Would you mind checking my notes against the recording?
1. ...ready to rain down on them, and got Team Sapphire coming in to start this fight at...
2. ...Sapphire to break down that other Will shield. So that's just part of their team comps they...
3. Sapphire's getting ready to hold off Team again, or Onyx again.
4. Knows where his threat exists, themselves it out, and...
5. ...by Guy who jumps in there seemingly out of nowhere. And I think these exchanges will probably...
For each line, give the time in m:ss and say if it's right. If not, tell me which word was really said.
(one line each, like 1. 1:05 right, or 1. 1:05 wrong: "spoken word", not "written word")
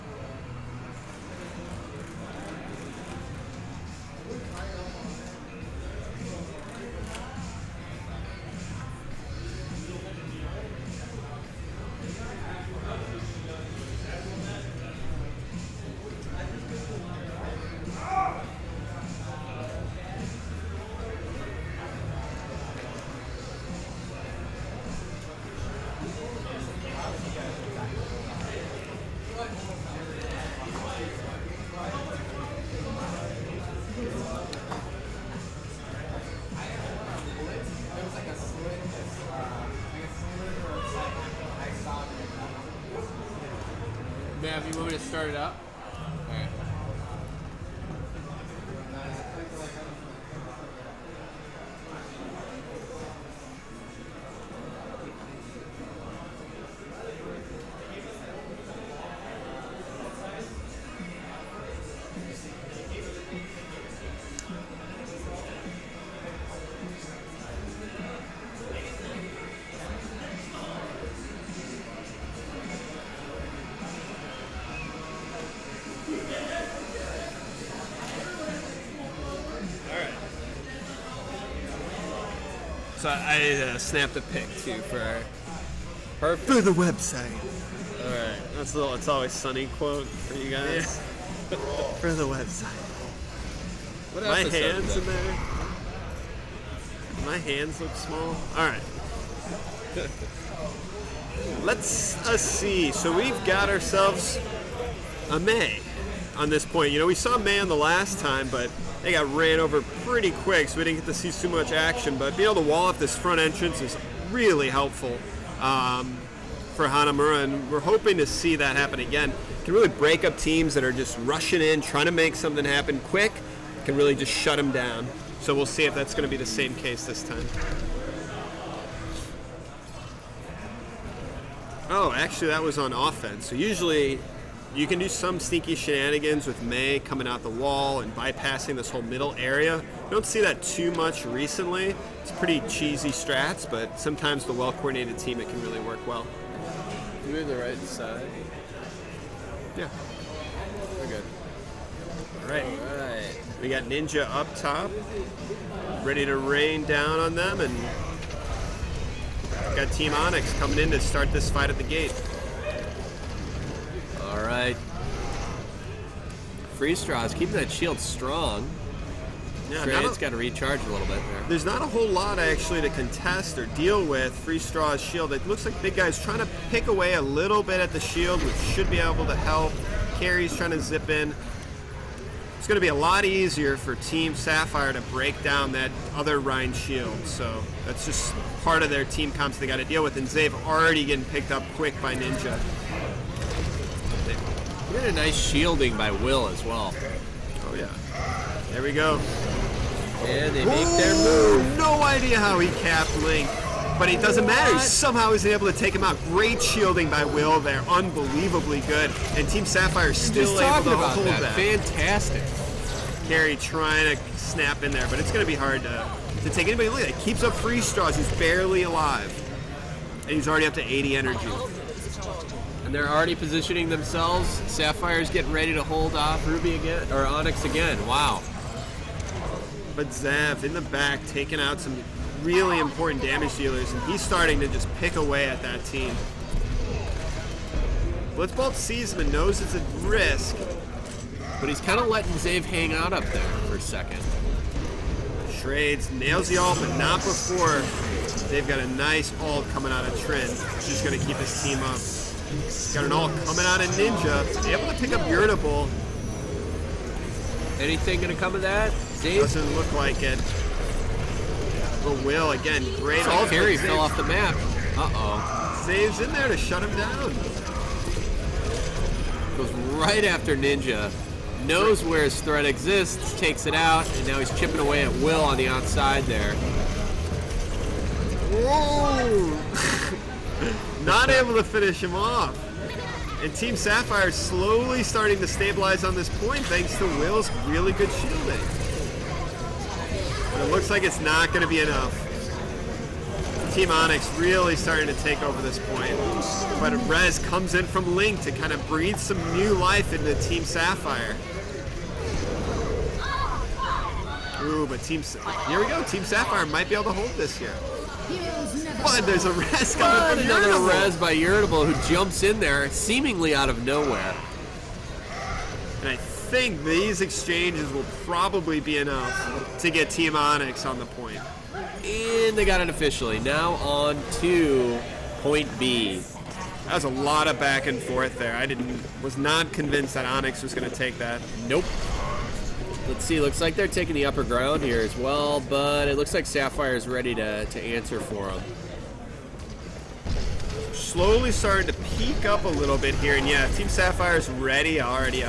1. 2:36 wrong: "Onyx", not "Sapphire"
2. 3:04 wrong: "Rein", not "Will"
3. 3:44 wrong: "Ruby", not "Team"
4. 4:31 wrong: "takes", not "themselves"
5. 5:11 wrong: "Irritable", not "Guy".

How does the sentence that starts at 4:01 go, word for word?
But he's kind of letting Zave hang out up there for a second.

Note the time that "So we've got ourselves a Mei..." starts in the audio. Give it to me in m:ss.
1:42.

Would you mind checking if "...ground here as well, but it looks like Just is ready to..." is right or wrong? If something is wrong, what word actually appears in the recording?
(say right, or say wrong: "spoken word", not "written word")
wrong: "Sapphire", not "Just".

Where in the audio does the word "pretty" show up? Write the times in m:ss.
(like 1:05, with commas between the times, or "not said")
1:50, 2:22.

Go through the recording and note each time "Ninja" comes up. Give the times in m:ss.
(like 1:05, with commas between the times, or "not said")
2:33, 3:12, 4:13, 4:30.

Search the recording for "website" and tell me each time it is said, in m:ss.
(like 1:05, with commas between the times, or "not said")
1:26, 1:32.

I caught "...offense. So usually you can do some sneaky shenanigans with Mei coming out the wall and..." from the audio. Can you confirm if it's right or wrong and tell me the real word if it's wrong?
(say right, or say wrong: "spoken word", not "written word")
right.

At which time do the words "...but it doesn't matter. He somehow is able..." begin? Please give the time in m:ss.
3:23.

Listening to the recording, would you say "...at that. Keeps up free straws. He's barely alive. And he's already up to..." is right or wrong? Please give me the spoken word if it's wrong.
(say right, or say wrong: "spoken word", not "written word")
right.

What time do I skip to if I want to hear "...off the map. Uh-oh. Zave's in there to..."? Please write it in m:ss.
4:23.